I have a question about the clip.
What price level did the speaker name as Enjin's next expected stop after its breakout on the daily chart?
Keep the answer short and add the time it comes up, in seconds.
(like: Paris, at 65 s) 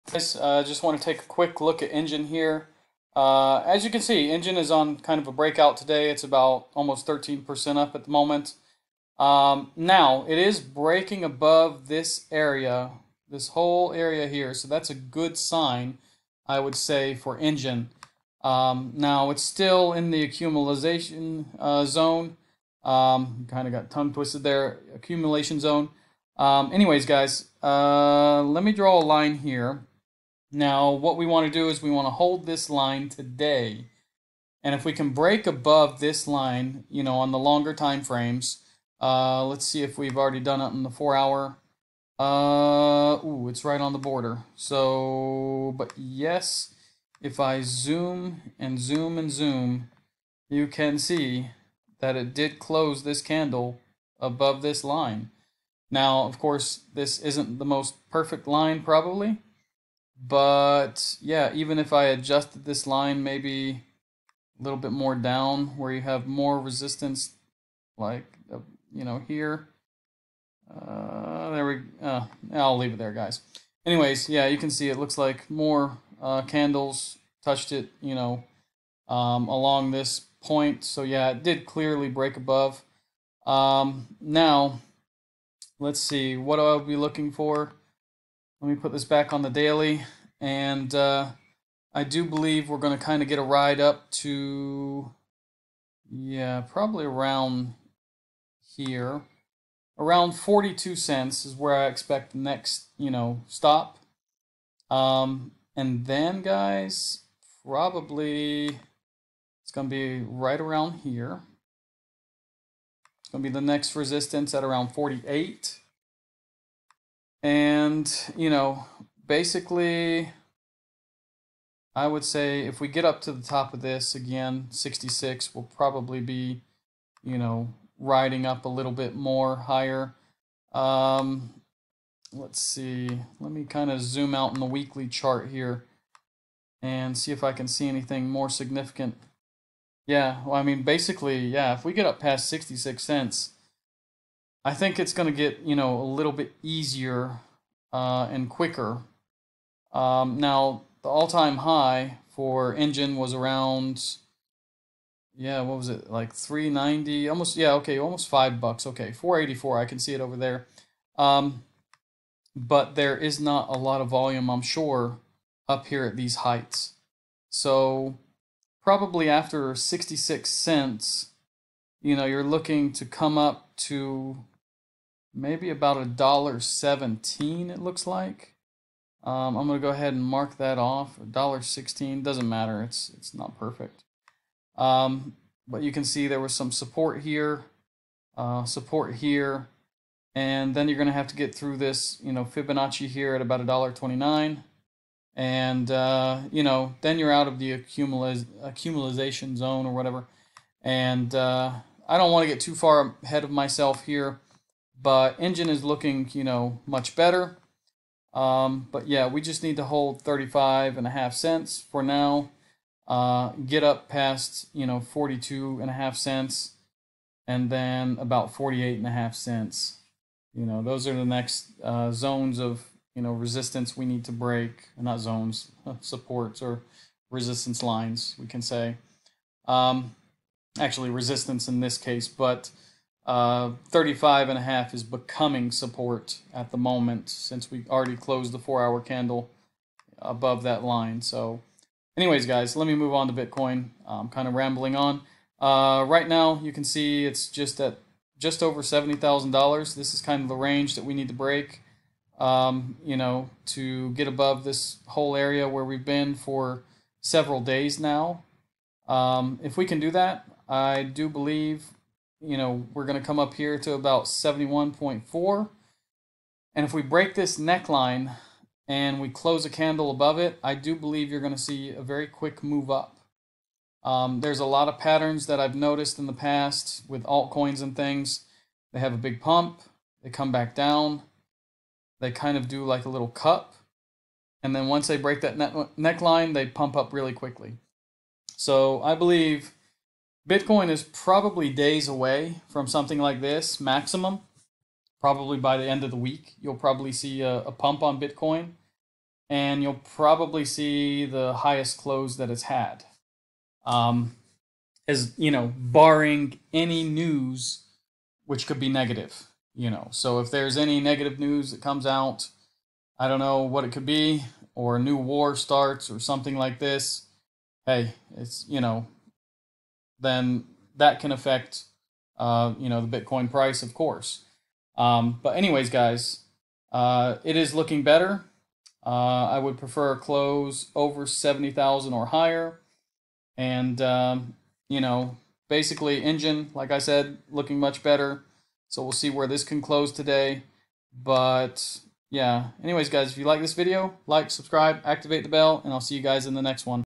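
42 cents, at 100 s.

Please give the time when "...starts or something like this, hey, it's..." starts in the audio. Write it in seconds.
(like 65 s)
315 s.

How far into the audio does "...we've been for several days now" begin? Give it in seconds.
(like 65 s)
255 s.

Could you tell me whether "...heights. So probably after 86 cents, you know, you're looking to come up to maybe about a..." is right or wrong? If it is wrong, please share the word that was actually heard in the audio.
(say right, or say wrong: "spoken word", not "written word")
wrong: "66", not "86".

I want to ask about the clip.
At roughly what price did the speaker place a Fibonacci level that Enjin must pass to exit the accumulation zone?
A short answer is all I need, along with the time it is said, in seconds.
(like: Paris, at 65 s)
$1.29, at 193 s.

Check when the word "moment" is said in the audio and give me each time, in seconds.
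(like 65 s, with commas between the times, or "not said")
8 s, 236 s.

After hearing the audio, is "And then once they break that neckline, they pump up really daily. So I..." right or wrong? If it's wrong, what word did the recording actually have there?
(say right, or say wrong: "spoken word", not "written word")
wrong: "quickly", not "daily".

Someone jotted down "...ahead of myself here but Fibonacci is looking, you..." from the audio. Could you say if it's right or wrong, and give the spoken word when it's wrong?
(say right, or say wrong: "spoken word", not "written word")
wrong: "Enjin", not "Fibonacci".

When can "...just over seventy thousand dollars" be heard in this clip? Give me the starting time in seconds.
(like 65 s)
248 s.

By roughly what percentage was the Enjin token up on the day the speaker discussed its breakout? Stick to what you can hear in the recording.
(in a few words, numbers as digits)
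almost 13%.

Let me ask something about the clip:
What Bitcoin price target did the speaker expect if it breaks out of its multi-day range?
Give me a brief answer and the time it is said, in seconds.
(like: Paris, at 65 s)
71.4, at 264 s.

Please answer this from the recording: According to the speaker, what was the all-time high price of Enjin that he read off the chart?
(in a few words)
$4.84.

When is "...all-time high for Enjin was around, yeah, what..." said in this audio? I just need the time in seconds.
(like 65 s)
151 s.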